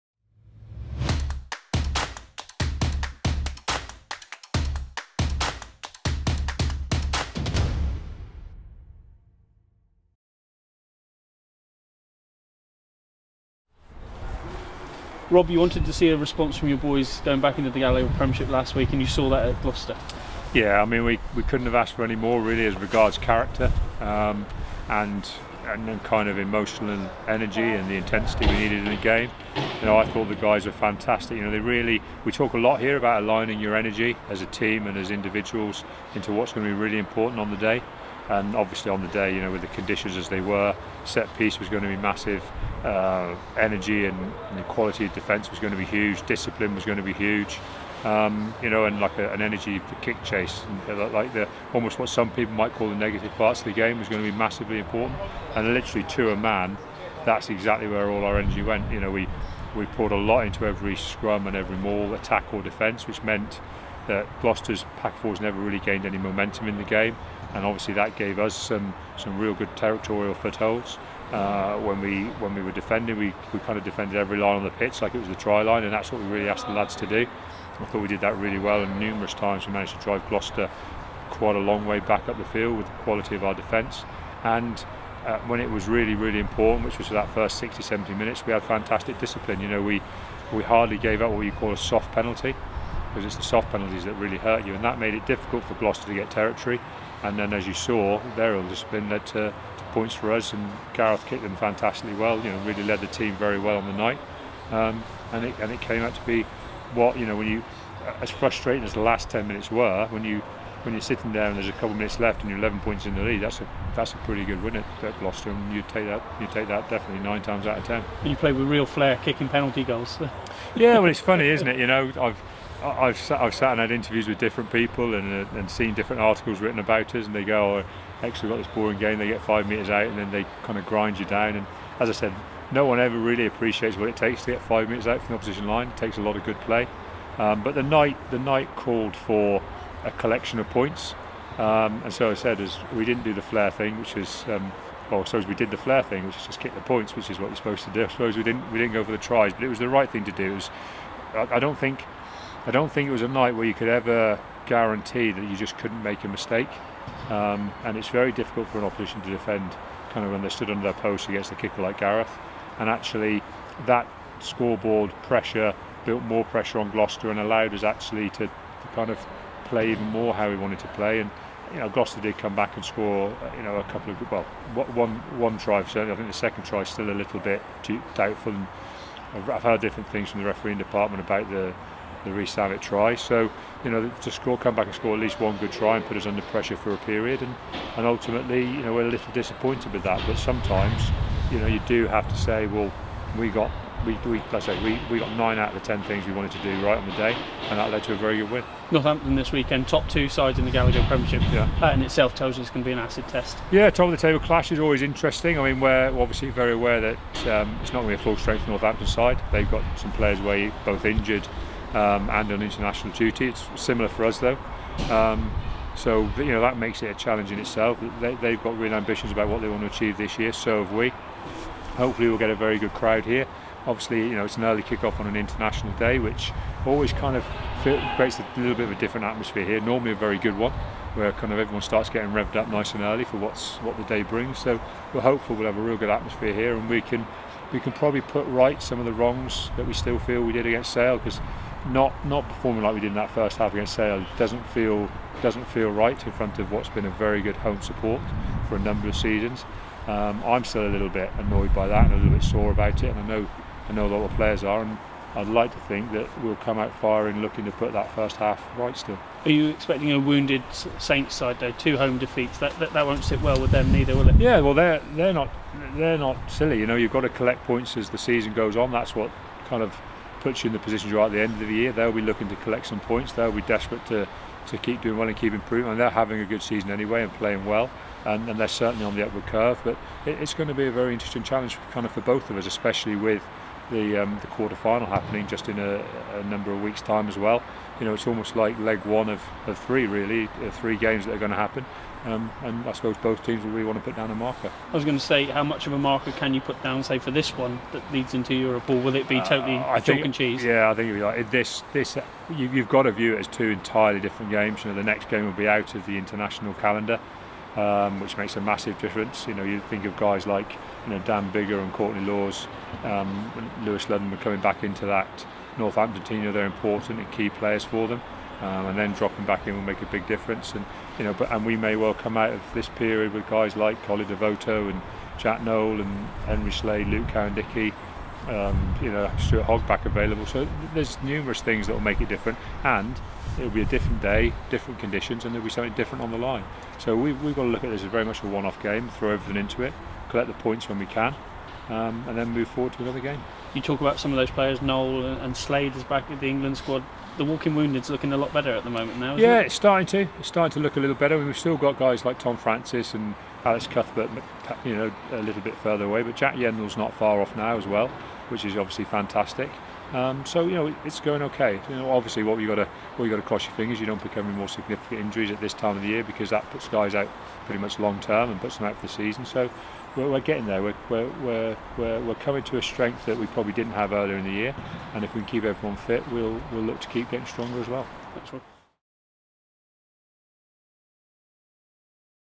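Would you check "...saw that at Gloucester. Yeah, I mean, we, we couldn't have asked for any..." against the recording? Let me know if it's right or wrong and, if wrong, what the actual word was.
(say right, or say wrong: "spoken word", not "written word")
right.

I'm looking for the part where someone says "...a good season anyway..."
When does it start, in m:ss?
4:36.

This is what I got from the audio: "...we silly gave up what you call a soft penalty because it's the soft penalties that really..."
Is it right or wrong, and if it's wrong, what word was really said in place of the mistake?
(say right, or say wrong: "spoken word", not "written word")
wrong: "hardly", not "silly".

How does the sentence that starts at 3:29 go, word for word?
They've got some players where both injured um, and on international duty.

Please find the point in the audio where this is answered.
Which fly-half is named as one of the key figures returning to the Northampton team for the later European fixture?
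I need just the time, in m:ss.
5:11.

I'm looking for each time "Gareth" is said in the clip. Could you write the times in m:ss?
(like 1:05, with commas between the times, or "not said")
1:40, 2:41.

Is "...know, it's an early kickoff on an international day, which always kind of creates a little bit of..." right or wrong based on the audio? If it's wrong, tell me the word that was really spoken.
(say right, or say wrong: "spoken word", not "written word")
right.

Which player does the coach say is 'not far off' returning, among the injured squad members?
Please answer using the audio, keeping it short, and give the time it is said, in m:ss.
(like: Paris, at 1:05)
Jack Yeandle, at 5:56.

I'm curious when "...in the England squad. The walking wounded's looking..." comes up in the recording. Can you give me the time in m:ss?
5:46.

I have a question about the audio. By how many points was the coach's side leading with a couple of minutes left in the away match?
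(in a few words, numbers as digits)
11.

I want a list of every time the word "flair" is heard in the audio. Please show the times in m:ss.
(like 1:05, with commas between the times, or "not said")
1:58.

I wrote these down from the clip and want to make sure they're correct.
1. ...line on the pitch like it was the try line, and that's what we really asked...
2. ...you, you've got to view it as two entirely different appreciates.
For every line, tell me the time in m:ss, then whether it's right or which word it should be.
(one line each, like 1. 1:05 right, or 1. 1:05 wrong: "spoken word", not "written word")
1. 1:14 right
2. 5:02 wrong: "games", not "appreciates".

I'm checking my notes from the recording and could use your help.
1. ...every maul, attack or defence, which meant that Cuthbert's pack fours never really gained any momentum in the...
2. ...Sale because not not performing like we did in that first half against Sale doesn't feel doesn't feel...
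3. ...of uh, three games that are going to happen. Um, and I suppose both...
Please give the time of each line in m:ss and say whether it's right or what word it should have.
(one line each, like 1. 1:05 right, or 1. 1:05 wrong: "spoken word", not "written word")
1. 1:01 wrong: "Gloucester", not "Cuthbert"
2. 4:00 right
3. 4:50 right.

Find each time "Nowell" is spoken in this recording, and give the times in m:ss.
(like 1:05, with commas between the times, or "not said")
5:25, 5:44.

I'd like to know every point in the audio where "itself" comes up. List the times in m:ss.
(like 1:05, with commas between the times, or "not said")
3:22, 3:37.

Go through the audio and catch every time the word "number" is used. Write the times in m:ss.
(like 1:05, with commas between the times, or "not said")
4:08, 4:46.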